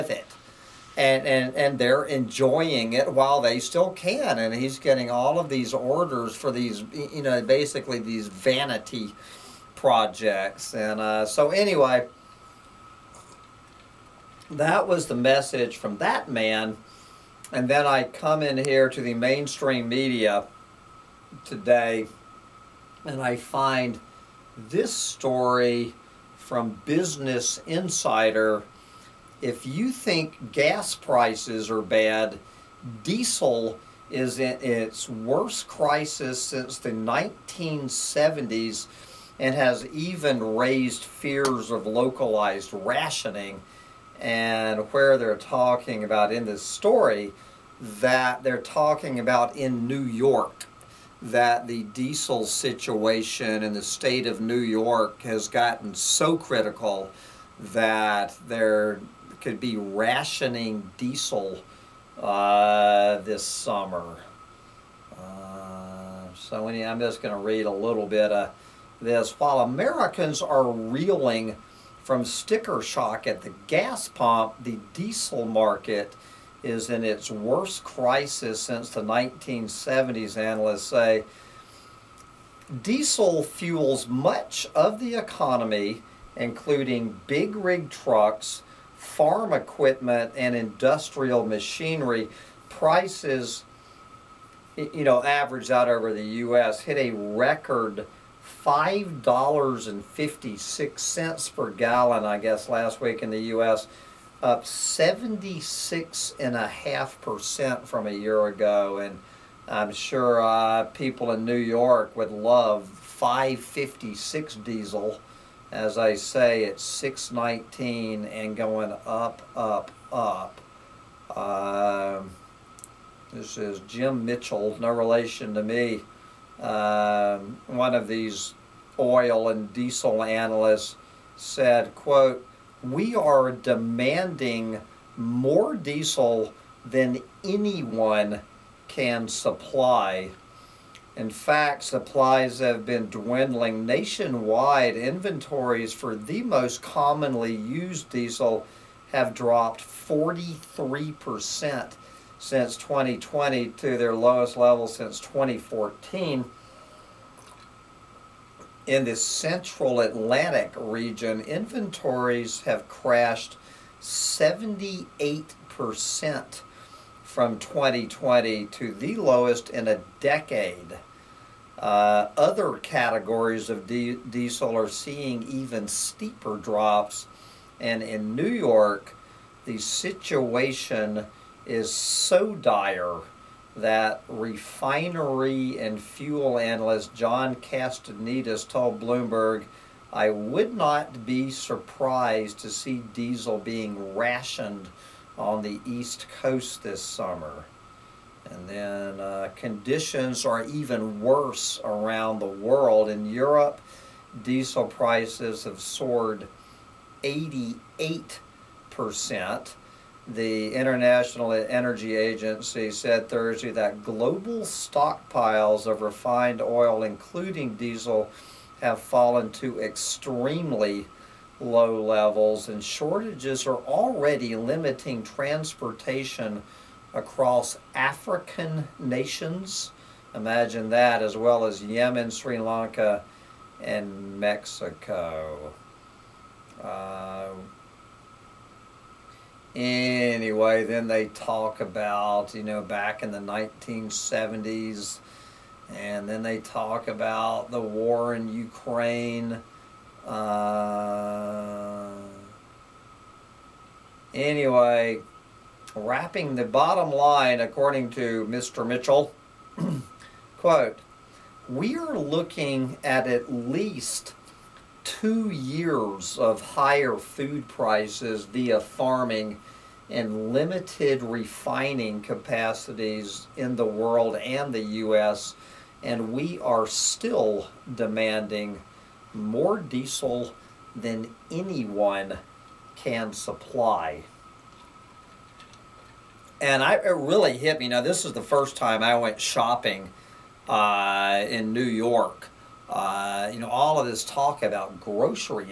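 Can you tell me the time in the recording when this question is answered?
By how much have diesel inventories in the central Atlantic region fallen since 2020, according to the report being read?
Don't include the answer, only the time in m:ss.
2:43.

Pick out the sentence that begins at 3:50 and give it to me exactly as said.
Imagine that, as well as Yemen, Sri Lanka, and Mexico.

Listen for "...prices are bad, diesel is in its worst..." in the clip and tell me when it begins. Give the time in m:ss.
0:30.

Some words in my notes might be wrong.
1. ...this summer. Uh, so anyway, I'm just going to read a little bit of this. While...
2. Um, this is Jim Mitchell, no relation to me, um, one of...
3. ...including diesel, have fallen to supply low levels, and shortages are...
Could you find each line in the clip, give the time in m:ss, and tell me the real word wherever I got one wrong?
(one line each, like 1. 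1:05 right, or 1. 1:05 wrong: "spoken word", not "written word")
1. 1:03 right
2. 2:01 right
3. 3:37 wrong: "extremely", not "supply".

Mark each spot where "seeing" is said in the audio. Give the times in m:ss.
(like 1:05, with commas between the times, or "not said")
2:54.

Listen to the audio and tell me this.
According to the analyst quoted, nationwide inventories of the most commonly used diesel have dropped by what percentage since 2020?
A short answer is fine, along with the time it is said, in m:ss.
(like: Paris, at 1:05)
43%, at 2:29.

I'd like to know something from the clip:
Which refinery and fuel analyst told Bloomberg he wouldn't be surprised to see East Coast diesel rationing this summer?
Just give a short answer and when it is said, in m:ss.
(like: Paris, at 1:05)
John Castaneda, at 3:07.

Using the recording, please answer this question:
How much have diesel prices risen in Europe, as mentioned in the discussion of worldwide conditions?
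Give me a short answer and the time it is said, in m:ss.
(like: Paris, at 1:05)
88%, at 3:27.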